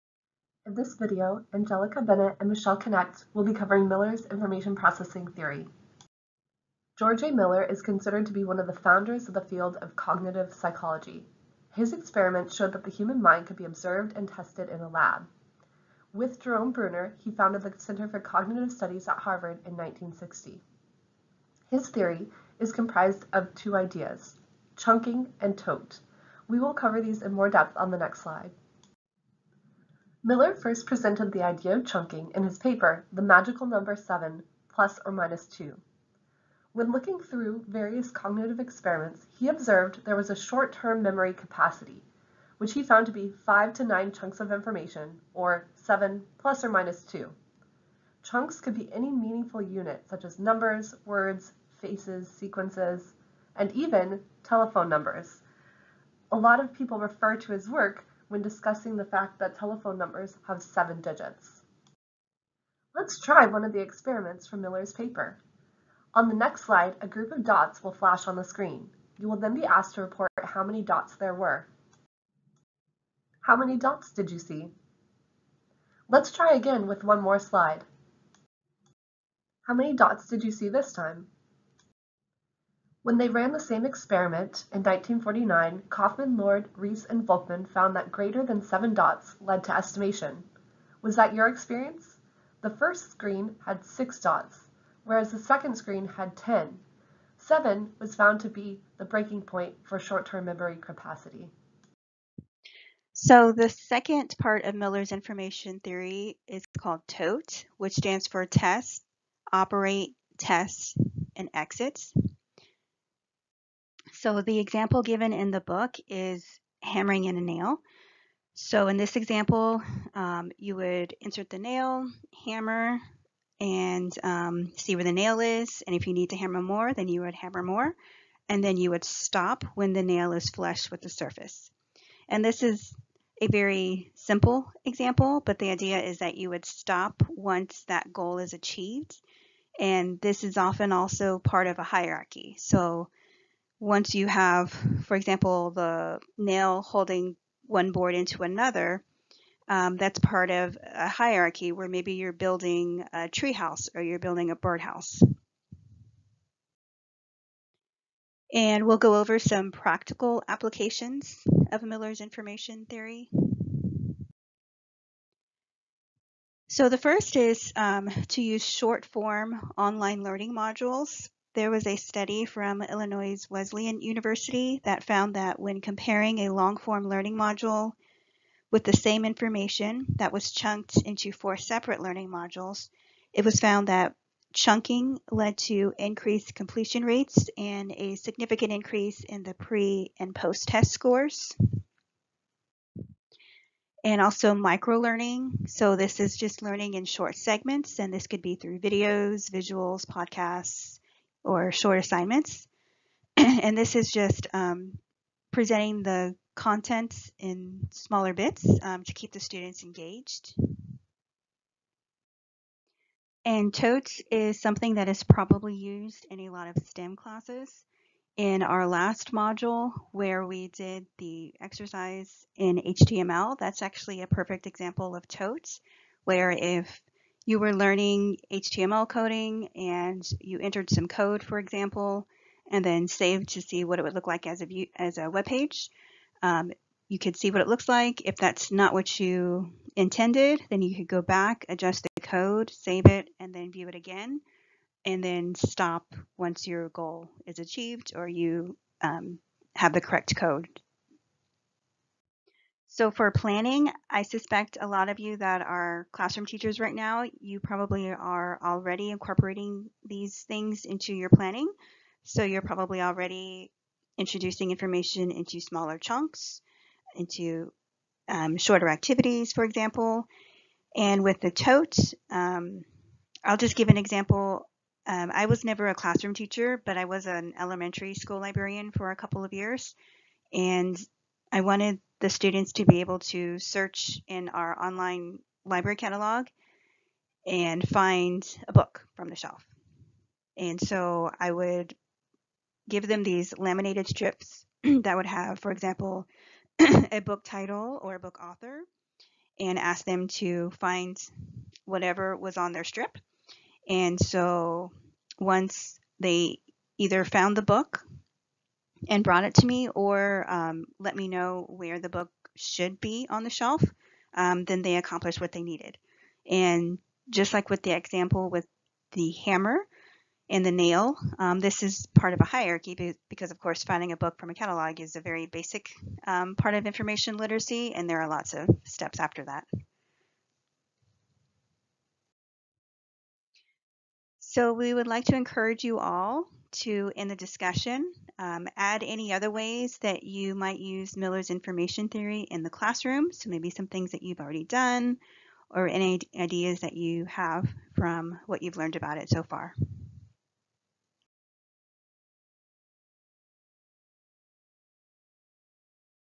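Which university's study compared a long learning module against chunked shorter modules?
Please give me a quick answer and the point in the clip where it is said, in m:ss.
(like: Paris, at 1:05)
Illinois Wesleyan University, at 2:52.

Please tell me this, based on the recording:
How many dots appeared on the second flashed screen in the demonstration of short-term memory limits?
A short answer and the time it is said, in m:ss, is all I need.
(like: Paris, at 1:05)
10, at 1:36.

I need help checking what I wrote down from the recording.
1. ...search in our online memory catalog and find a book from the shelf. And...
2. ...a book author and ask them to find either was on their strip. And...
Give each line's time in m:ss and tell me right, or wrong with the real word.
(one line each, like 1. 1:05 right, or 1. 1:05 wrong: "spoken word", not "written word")
1. 4:43 wrong: "library", not "memory"
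2. 4:58 wrong: "whatever", not "either".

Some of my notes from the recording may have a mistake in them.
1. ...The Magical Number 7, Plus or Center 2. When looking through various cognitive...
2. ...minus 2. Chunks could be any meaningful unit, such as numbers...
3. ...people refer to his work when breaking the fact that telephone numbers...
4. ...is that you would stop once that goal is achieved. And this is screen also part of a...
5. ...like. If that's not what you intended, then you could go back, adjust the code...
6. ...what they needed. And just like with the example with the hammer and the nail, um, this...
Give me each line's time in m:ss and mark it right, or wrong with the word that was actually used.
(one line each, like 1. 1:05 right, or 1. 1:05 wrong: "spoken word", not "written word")
1. 0:33 wrong: "Minus", not "Center"
2. 0:46 right
3. 0:56 wrong: "discussing", not "breaking"
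4. 2:15 wrong: "often", not "screen"
5. 3:57 right
6. 5:15 right.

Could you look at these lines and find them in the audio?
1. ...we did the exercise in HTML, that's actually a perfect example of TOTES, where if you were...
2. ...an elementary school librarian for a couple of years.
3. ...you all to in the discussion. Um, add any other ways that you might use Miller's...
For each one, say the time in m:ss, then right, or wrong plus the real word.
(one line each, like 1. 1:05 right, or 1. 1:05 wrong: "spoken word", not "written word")
1. 3:40 right
2. 4:37 right
3. 5:35 right.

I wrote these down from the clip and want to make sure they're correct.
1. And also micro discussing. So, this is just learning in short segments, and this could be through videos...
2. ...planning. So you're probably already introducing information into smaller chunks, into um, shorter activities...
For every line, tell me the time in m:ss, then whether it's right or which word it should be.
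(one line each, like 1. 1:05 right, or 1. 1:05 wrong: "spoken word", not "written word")
1. 3:14 wrong: "learning", not "discussing"
2. 4:21 right.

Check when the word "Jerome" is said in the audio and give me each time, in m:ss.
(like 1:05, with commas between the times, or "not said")
0:16.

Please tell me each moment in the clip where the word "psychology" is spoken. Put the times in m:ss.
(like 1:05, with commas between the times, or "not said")
0:10.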